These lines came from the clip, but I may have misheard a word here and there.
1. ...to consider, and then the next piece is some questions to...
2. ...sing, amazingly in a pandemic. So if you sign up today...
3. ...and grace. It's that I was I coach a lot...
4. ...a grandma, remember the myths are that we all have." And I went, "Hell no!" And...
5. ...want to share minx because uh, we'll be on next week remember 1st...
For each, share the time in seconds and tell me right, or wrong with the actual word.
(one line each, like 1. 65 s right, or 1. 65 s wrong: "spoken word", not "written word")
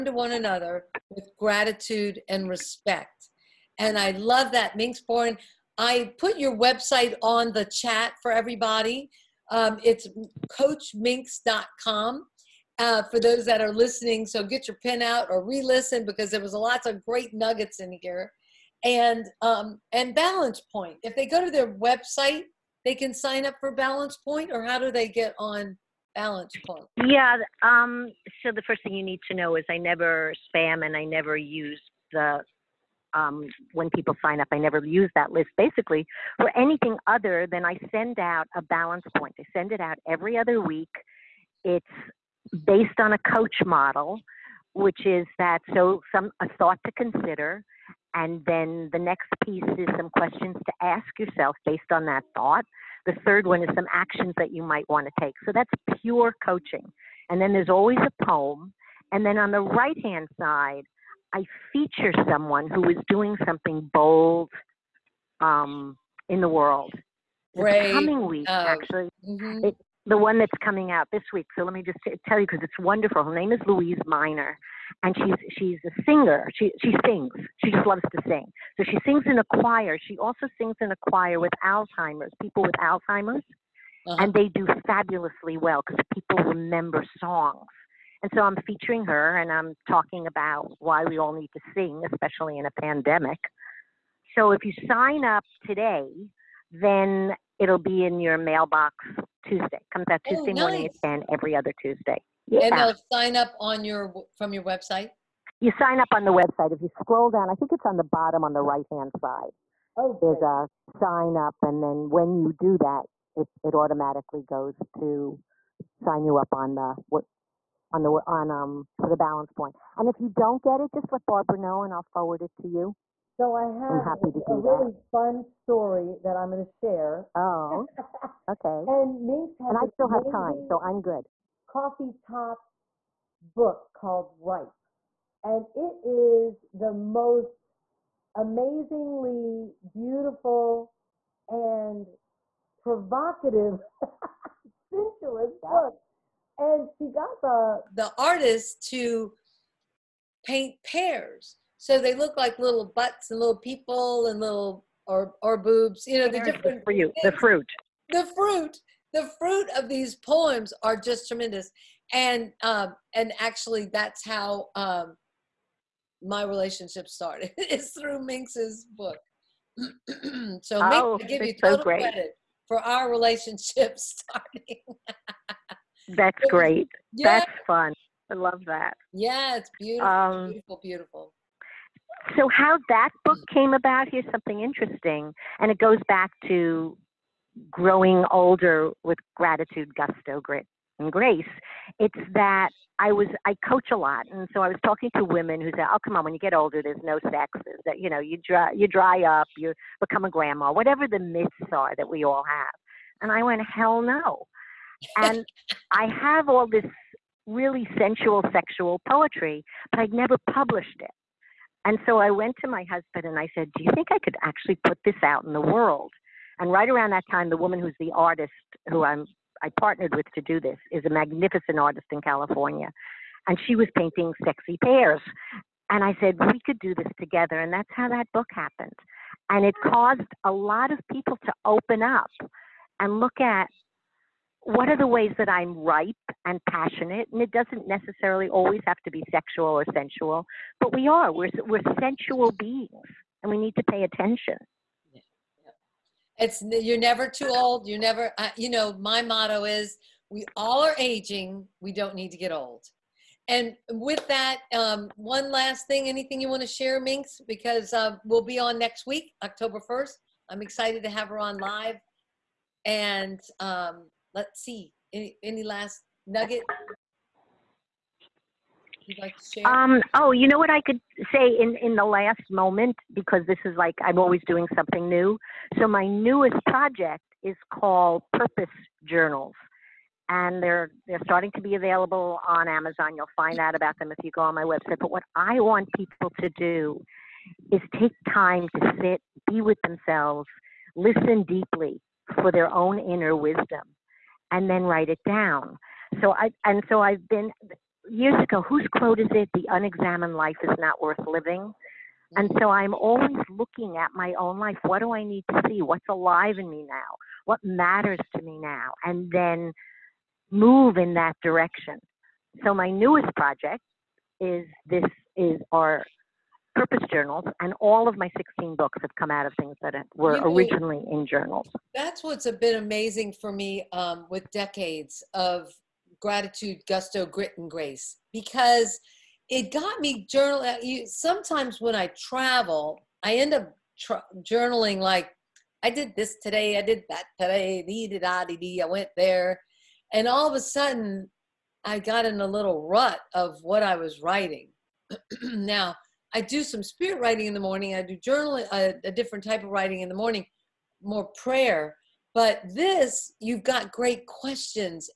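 1. 46 s right
2. 91 s wrong: "especially", not "amazingly"
3. 190 s right
4. 200 s wrong: "whatever", not "remember"
5. 256 s wrong: "october", not "remember".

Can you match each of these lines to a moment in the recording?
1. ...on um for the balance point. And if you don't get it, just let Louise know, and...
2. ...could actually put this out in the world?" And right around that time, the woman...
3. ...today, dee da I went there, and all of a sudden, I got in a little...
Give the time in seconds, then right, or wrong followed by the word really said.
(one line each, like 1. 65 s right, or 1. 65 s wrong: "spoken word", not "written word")
1. 118 s wrong: "Barbara", not "Louise"
2. 214 s right
3. 337 s right.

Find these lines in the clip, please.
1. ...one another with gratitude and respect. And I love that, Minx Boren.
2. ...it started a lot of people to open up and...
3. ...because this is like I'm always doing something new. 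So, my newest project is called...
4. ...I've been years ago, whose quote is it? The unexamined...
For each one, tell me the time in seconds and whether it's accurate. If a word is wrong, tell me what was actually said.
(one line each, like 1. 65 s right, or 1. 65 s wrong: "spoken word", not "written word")
1. 0 s right
2. 229 s wrong: "caused", not "started"
3. 273 s right
4. 297 s right.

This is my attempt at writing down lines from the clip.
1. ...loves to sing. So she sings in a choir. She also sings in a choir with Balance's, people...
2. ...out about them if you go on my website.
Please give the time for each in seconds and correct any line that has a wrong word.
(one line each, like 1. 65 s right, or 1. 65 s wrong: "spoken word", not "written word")
1. 77 s wrong: "Alzheimer", not "Balance"
2. 283 s right.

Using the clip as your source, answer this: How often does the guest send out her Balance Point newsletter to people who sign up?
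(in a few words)
Every other week.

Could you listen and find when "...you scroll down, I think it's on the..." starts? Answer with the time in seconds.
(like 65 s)
106 s.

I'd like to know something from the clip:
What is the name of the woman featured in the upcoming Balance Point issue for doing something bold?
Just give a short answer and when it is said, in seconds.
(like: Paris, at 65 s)
Louise Miner, at 73 s.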